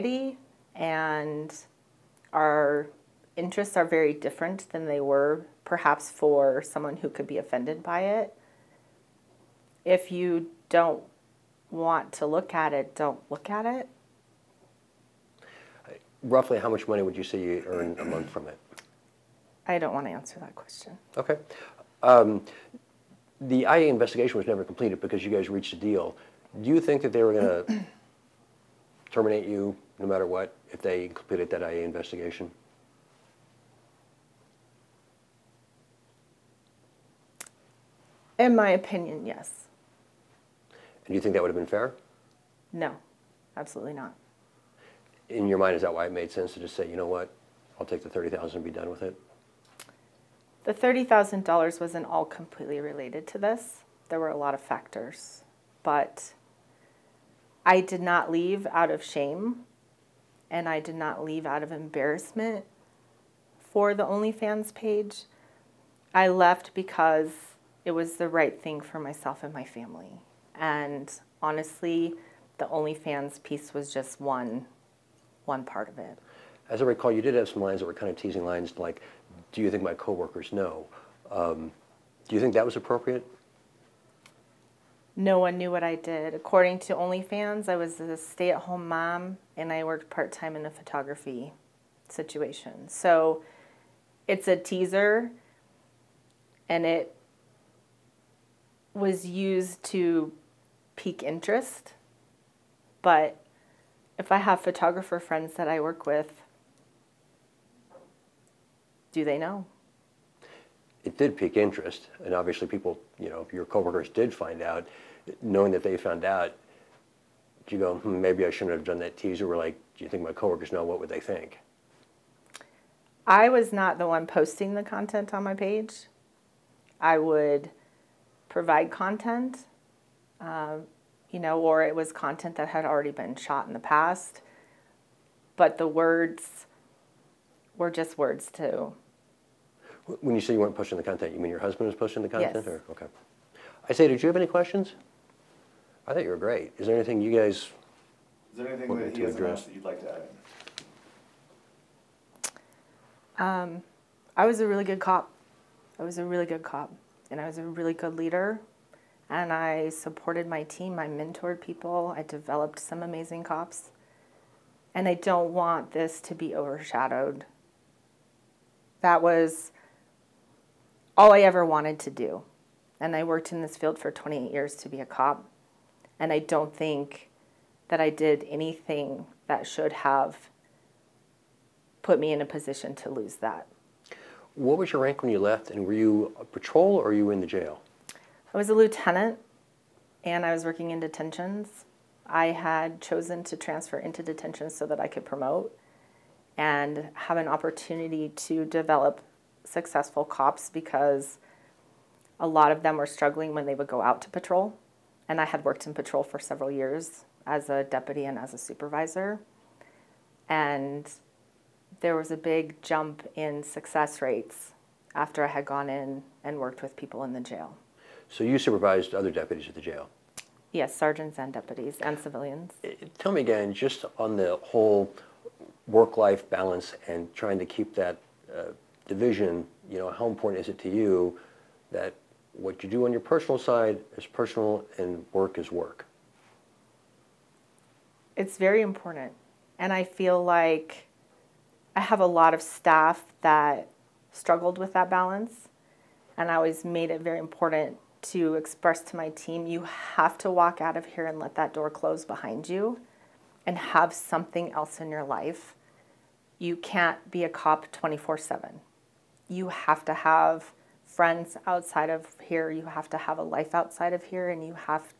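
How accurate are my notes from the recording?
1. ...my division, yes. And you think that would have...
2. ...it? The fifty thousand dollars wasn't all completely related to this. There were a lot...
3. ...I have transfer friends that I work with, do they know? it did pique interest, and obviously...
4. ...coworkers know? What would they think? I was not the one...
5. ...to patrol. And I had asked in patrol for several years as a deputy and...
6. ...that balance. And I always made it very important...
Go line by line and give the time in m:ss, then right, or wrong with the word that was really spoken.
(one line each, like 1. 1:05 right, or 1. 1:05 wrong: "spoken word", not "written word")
1. 0:38 wrong: "opinion", not "division"
2. 0:49 wrong: "thirty", not "fifty"
3. 1:44 wrong: "photographer", not "transfer"
4. 2:00 right
5. 3:24 wrong: "worked", not "asked"
6. 4:04 right.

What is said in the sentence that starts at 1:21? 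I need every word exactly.
Um, do you think that was appropriate?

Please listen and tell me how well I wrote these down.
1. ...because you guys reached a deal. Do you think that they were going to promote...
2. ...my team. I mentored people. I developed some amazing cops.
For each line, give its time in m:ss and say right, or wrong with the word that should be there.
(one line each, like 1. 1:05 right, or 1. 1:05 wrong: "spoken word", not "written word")
1. 0:25 wrong: "terminate", not "promote"
2. 2:40 right.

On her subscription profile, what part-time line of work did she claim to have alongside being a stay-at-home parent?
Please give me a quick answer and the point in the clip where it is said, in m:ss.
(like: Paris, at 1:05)
Photography, at 1:30.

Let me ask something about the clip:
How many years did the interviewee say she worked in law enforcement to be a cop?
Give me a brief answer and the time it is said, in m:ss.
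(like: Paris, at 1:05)
28, at 2:54.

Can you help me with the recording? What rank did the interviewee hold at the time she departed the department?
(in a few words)
Lieutenant.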